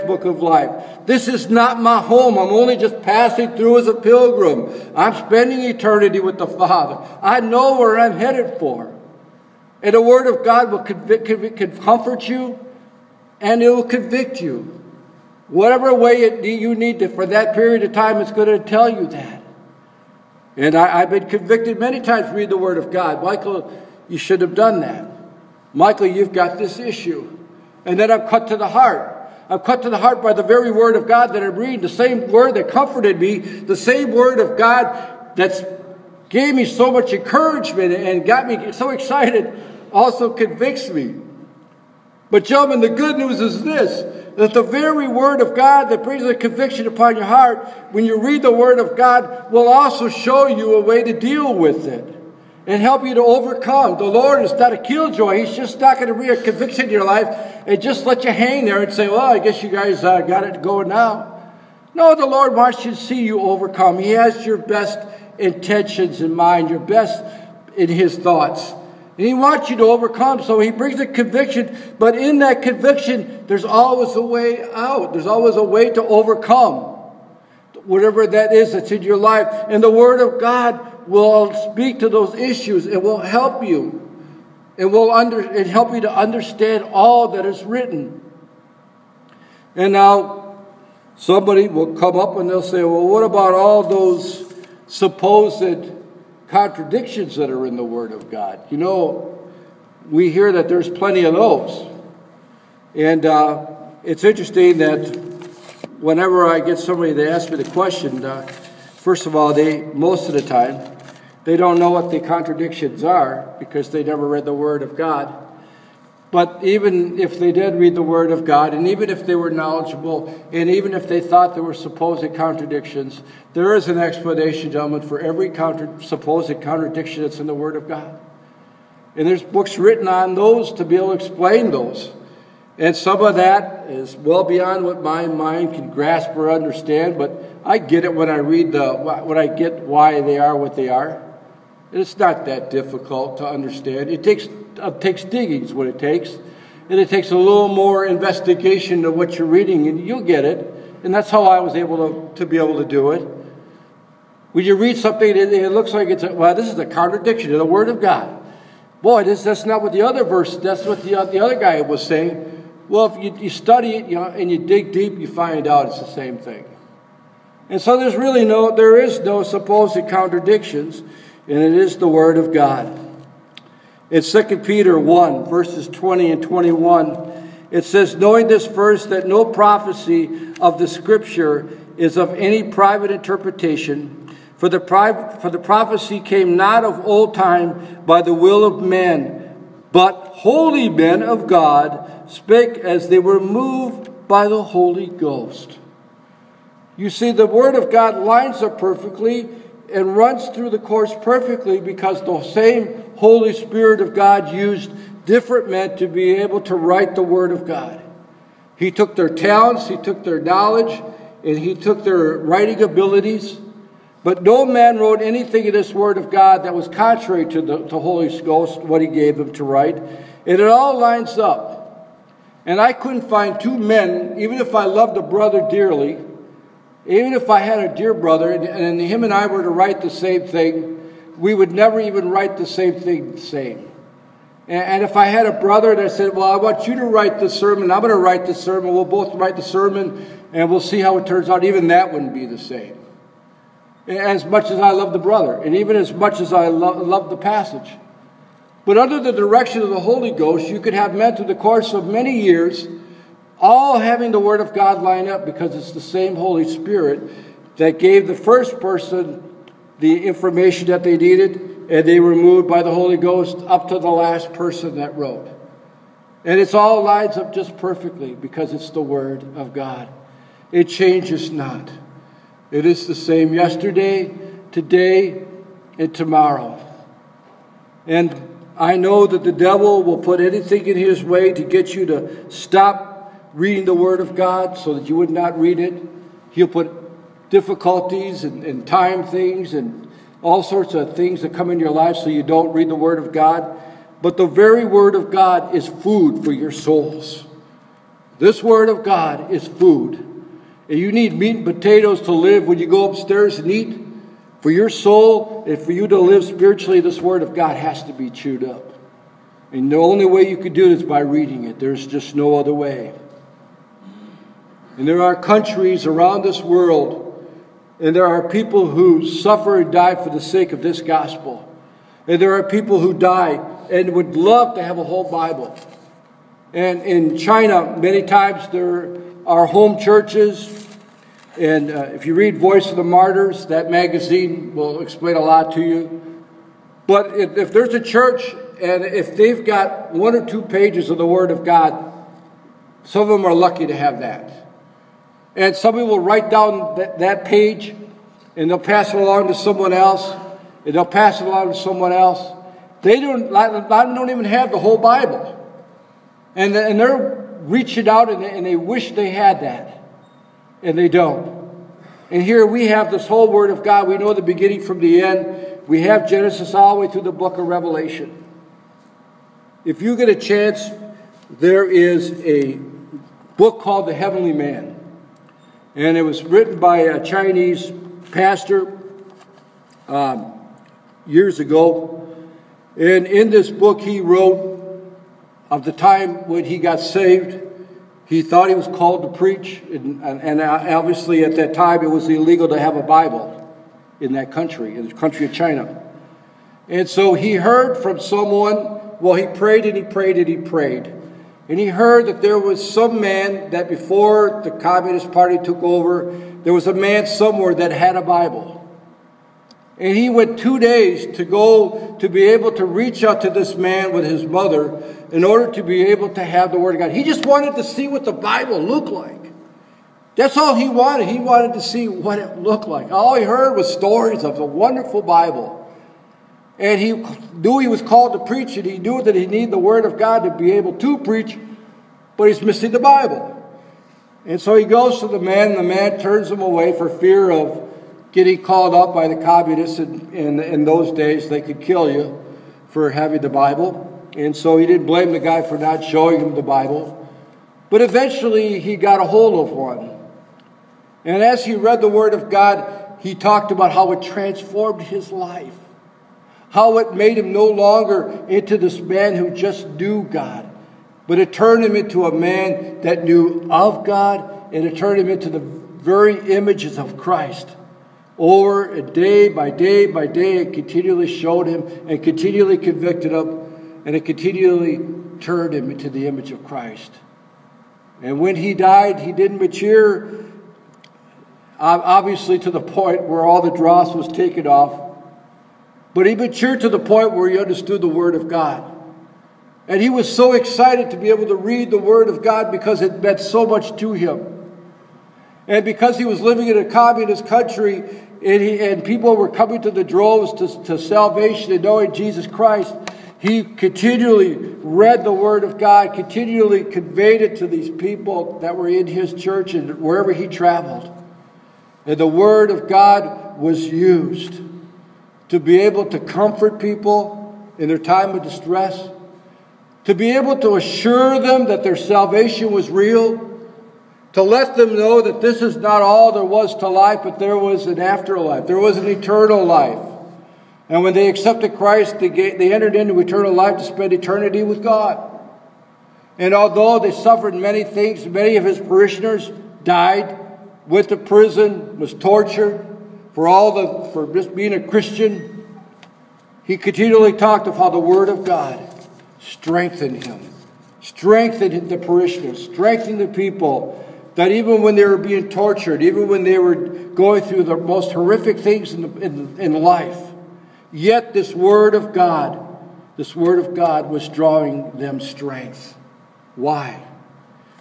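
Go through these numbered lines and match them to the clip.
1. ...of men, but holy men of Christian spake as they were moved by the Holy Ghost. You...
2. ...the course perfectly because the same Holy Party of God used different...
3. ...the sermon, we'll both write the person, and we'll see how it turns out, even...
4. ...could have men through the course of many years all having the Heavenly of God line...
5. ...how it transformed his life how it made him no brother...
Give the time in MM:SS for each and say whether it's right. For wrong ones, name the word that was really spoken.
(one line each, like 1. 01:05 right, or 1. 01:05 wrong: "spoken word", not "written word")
1. 03:08 wrong: "God", not "Christian"
2. 03:20 wrong: "Spirit", not "Party"
3. 03:58 wrong: "sermon", not "person"
4. 04:10 wrong: "Word", not "Heavenly"
5. 07:33 wrong: "longer", not "brother".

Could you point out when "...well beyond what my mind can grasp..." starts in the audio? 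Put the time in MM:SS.
02:14.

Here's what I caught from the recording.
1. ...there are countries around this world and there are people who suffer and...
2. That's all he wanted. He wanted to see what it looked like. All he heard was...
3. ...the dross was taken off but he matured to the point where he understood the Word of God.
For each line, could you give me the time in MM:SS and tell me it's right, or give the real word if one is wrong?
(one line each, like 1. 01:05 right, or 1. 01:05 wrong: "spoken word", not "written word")
1. 05:15 right
2. 07:00 right
3. 08:03 right.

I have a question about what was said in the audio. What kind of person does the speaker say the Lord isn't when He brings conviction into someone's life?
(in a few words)
a killjoy.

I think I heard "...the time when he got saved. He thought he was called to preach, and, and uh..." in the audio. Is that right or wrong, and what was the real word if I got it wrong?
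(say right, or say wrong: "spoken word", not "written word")
right.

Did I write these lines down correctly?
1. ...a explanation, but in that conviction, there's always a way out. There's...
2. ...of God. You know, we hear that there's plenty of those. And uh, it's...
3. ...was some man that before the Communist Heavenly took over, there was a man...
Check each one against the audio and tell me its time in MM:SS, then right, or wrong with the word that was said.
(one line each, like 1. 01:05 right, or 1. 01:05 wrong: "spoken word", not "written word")
1. 01:10 wrong: "conviction", not "explanation"
2. 01:38 right
3. 06:42 wrong: "Party", not "Heavenly".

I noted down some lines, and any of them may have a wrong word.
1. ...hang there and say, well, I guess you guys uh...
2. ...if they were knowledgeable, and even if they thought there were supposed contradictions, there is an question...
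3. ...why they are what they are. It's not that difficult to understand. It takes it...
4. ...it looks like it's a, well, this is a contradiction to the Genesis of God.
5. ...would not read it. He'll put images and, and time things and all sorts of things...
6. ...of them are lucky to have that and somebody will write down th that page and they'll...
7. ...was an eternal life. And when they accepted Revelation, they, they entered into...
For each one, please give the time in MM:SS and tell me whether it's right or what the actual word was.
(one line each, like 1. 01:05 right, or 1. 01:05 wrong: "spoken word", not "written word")
1. 00:58 right
2. 01:59 wrong: "explanation", not "question"
3. 02:19 right
4. 02:35 wrong: "Word", not "Genesis"
5. 04:45 wrong: "difficulties", not "images"
6. 05:43 right
7. 08:48 wrong: "Christ", not "Revelation".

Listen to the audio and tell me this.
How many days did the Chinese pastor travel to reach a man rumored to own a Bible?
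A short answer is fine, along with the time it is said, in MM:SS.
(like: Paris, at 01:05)
2, at 06:50.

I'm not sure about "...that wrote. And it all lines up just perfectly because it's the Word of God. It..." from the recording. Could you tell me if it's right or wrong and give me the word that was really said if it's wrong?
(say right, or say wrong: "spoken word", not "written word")
right.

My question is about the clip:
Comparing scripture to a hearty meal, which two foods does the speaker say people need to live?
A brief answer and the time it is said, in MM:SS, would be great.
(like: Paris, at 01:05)
meat and potatoes, at 05:01.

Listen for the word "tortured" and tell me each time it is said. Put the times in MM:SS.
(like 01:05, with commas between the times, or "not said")
09:02, 09:15.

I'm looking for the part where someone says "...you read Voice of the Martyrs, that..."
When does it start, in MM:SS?
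05:32.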